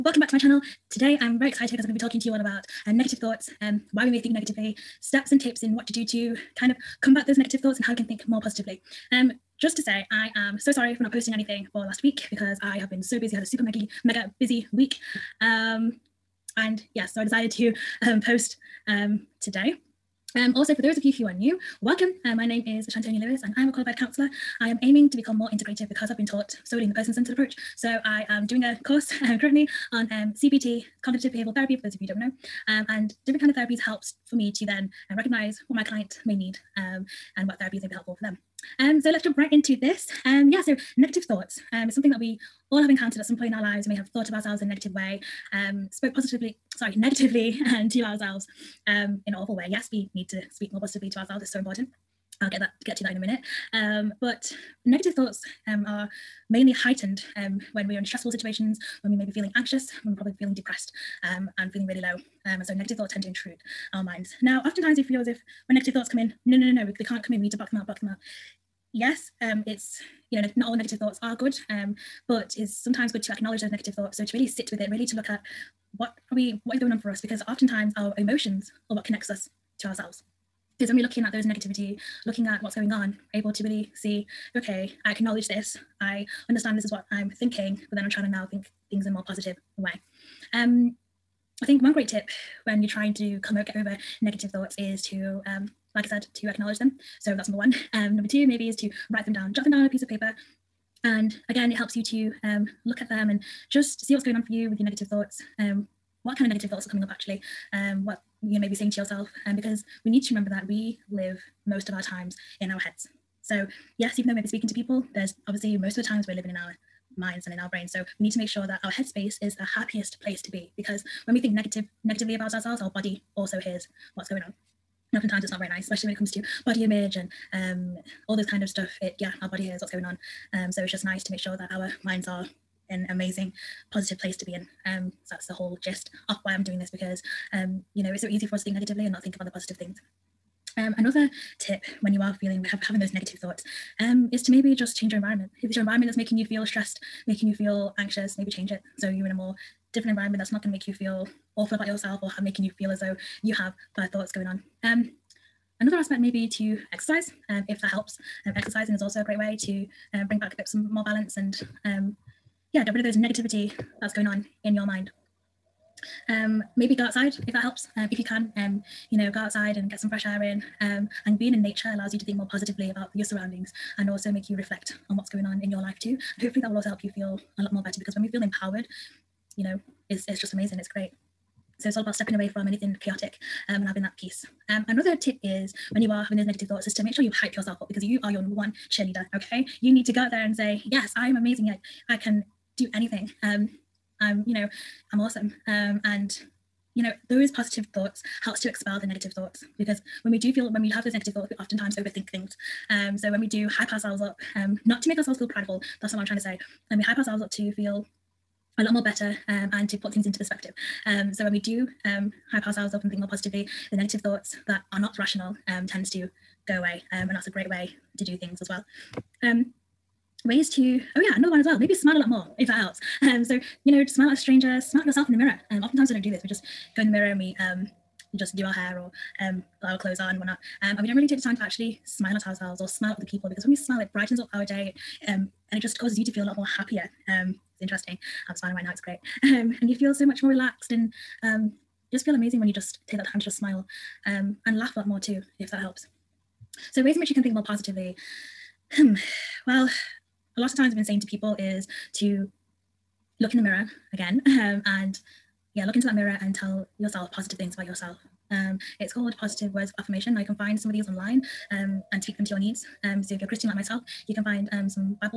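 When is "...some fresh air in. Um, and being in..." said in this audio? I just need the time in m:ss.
2:49.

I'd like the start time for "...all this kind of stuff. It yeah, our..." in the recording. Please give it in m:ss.
2:08.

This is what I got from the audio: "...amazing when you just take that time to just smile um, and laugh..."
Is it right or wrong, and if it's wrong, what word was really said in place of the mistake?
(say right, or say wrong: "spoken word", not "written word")
right.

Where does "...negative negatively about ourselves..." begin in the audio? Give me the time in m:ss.
2:01.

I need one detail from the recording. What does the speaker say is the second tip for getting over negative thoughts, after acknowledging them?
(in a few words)
write them down.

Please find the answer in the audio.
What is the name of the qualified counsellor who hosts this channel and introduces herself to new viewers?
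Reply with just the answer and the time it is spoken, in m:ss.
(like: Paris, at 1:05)
Shantonia Lewis, at 0:22.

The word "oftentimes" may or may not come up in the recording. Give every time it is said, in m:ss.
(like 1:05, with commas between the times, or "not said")
1:04, 1:17, 2:05, 3:21, 3:45.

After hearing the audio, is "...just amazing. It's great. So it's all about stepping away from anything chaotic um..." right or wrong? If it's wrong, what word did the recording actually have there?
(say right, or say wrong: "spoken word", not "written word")
right.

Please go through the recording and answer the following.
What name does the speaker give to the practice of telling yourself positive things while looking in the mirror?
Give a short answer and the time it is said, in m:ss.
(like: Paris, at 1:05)
Positive Words of Affirmation, at 4:19.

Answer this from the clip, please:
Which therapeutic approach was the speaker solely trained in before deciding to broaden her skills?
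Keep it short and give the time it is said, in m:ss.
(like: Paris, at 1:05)
person centred approach, at 0:26.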